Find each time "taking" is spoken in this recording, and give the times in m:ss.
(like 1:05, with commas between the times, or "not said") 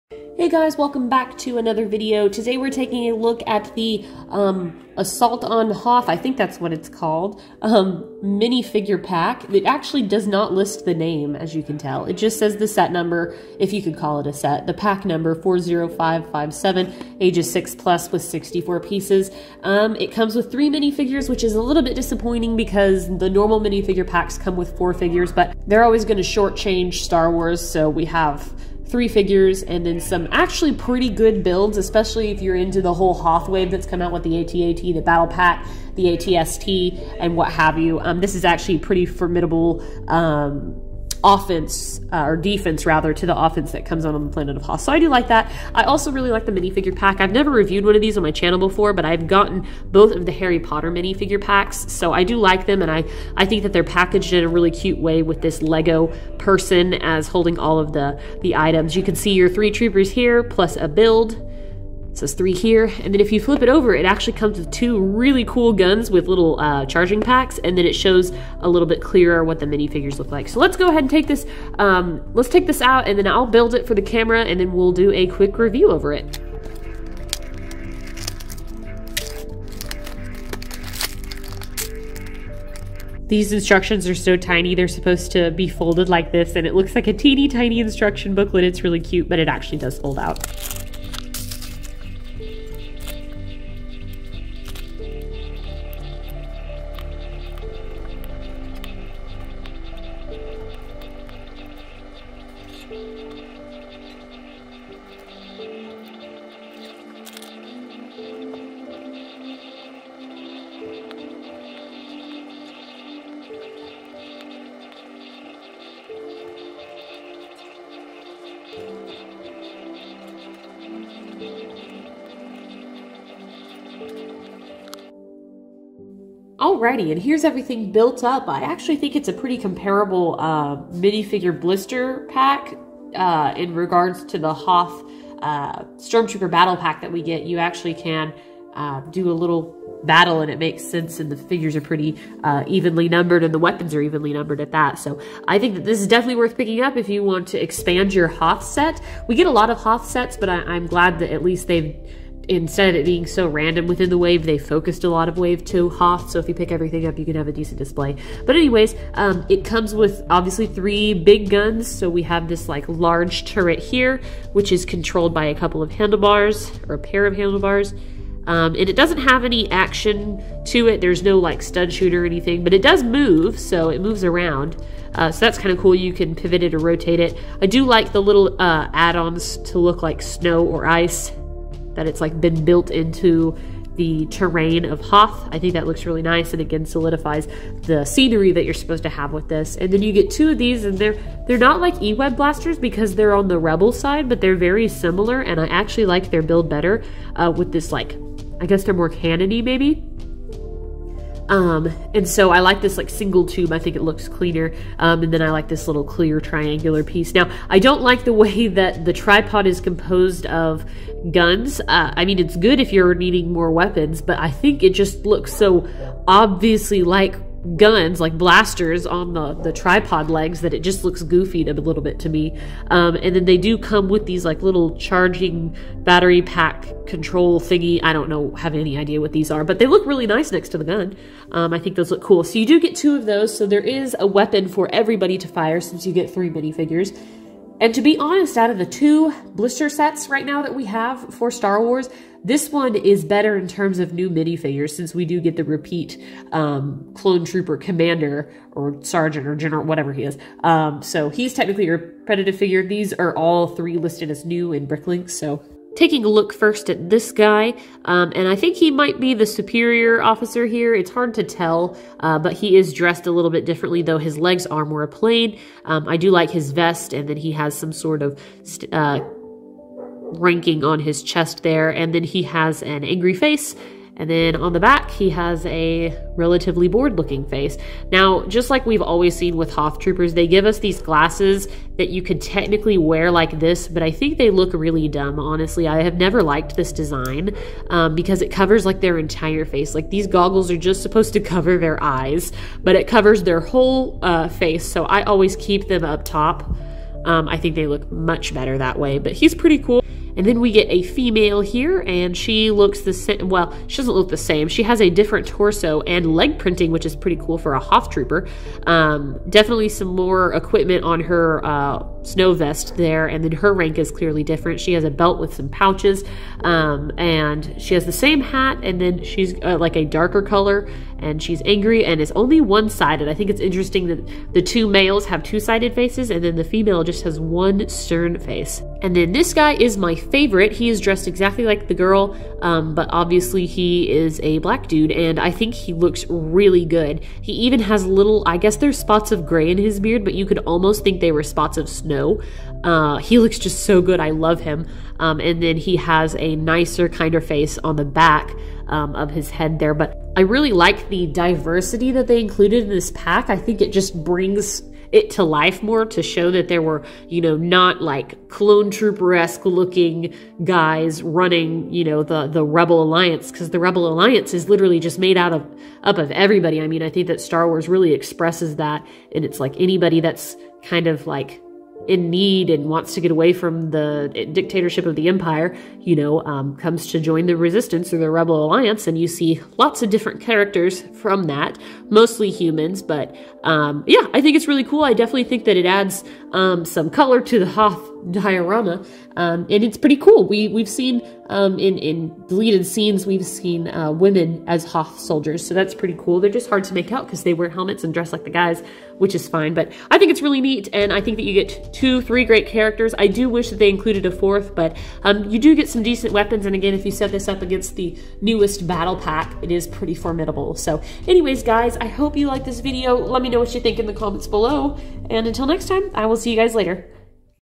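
0:02, 4:15.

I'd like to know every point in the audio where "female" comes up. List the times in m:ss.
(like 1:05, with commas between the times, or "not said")
5:01, 5:26.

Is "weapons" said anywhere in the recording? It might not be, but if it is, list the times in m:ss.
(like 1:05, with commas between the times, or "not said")
2:23, 3:33, 3:54, 6:46.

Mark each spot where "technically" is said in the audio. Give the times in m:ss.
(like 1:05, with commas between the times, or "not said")
4:11, 4:42.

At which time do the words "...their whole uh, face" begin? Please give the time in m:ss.
4:53.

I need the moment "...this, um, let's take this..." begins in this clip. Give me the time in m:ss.
1:11.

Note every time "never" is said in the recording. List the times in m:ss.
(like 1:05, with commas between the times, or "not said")
0:47, 4:46.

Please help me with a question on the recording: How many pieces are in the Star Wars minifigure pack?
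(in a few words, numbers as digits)
64.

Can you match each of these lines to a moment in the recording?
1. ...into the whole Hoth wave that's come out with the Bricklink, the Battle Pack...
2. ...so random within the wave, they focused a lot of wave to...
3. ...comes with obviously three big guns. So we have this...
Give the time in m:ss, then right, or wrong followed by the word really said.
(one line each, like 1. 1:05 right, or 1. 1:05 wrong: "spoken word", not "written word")
1. 0:32 wrong: "ATAT", not "Bricklink"
2. 2:33 right
3. 2:39 right.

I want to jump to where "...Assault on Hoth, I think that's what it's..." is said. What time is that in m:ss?
0:04.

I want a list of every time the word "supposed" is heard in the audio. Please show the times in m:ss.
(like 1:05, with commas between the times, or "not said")
1:24, 3:08, 4:51.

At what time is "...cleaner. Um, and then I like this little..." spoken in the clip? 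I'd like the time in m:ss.
3:24.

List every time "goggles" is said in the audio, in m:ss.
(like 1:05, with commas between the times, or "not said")
4:50.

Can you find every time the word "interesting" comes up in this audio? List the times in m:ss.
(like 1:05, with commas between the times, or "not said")
5:23.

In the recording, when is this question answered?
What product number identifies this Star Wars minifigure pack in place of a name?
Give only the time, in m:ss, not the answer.
0:15.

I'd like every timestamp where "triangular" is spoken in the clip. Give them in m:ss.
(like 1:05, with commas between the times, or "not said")
3:26.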